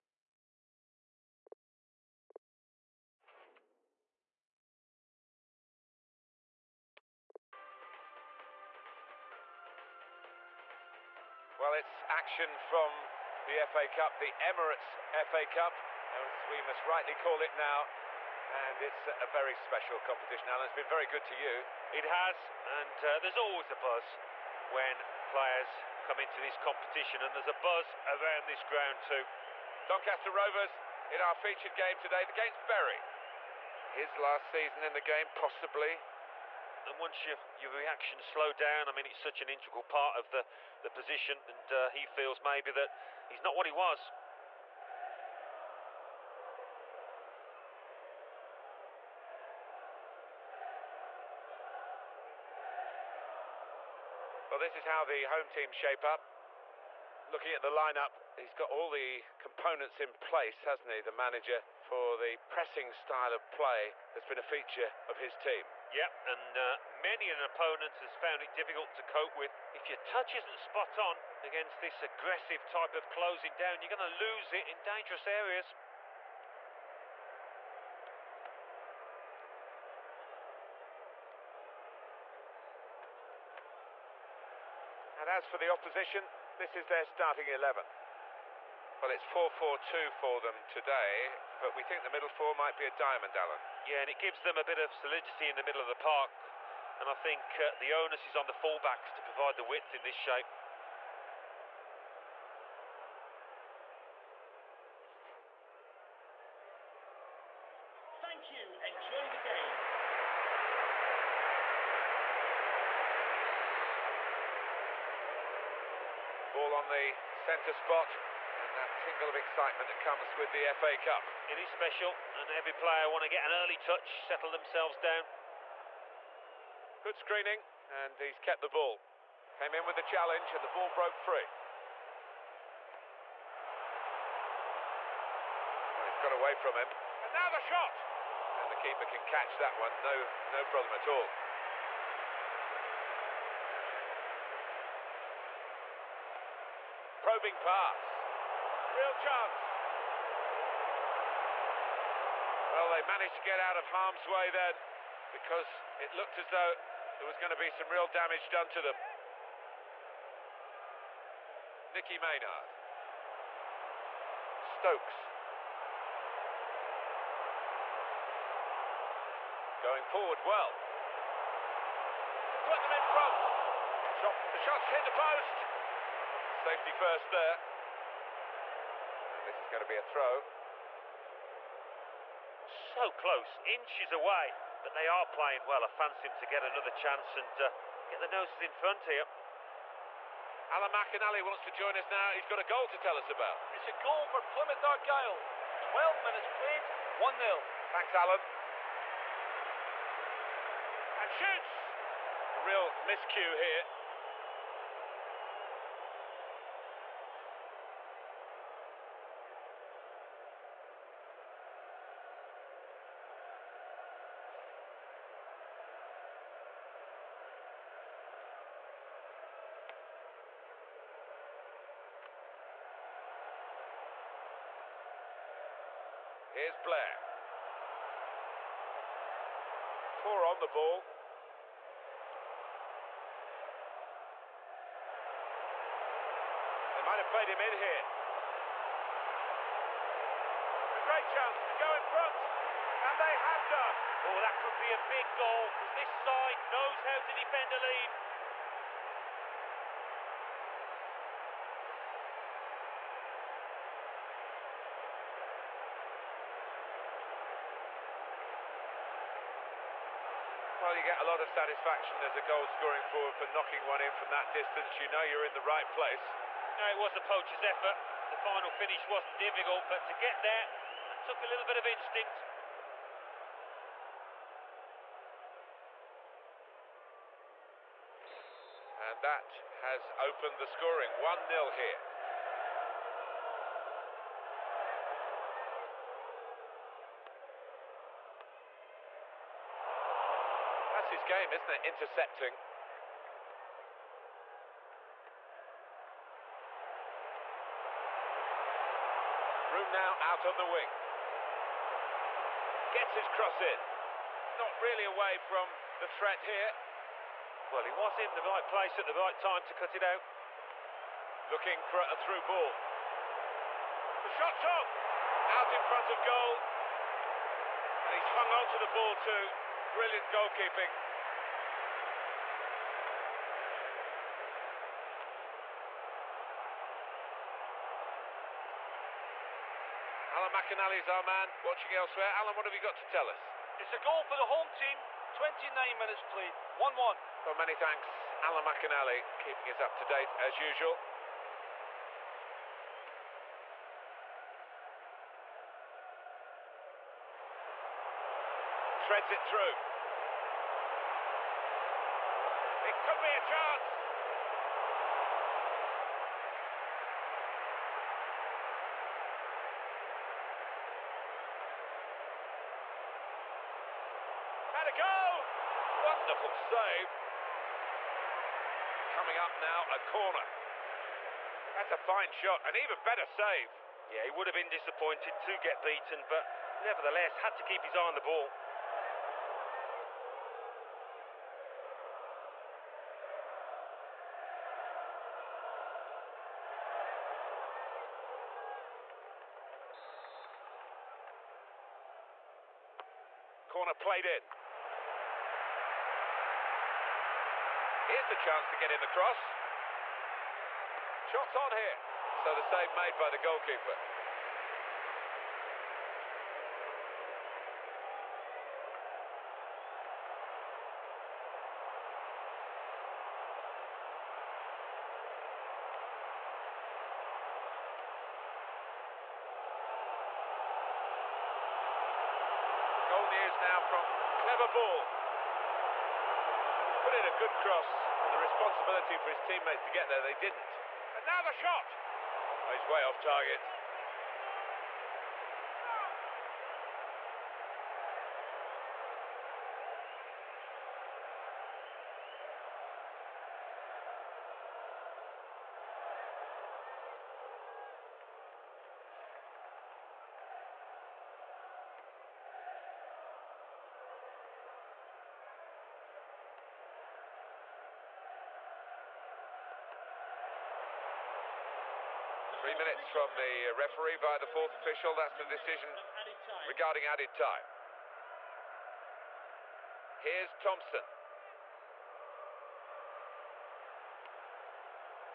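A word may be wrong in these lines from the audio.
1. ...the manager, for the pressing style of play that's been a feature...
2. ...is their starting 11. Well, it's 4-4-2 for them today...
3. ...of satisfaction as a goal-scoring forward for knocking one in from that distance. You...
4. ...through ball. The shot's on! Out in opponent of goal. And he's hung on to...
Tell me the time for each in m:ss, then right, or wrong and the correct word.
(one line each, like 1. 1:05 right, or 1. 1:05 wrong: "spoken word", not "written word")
1. 1:01 right
2. 1:26 right
3. 4:21 right
4. 5:12 wrong: "front", not "opponent".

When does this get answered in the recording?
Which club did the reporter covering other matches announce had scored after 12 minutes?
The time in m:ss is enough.
3:14.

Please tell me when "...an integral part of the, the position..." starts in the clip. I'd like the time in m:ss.
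0:39.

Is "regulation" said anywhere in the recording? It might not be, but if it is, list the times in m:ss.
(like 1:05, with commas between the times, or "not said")
not said.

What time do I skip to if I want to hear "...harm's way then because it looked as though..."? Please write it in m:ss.
2:33.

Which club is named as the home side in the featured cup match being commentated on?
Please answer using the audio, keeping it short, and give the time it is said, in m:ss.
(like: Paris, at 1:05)
Doncaster Rovers, at 0:29.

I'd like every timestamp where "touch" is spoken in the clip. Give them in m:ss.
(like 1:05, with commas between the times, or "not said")
1:09, 2:03.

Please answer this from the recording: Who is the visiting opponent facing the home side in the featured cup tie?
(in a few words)
Bury.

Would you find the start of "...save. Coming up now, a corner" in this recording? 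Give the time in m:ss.
6:06.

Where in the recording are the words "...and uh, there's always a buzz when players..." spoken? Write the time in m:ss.
0:22.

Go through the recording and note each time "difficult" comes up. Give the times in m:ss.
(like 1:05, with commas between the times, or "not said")
1:08, 4:29.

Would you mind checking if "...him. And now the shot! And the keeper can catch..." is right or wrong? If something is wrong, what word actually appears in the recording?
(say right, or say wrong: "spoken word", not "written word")
right.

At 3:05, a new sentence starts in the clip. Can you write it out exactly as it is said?
I fancy him to get another chance and uh, get the noses in front here.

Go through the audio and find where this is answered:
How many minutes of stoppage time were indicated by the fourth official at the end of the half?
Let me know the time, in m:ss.
7:42.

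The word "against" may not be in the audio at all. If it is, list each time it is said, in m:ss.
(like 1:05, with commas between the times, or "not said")
0:32, 1:11.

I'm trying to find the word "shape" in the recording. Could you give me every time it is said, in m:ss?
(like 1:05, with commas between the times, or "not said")
0:55, 1:40.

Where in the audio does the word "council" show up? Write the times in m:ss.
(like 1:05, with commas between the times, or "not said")
not said.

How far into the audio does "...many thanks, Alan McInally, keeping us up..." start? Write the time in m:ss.
5:37.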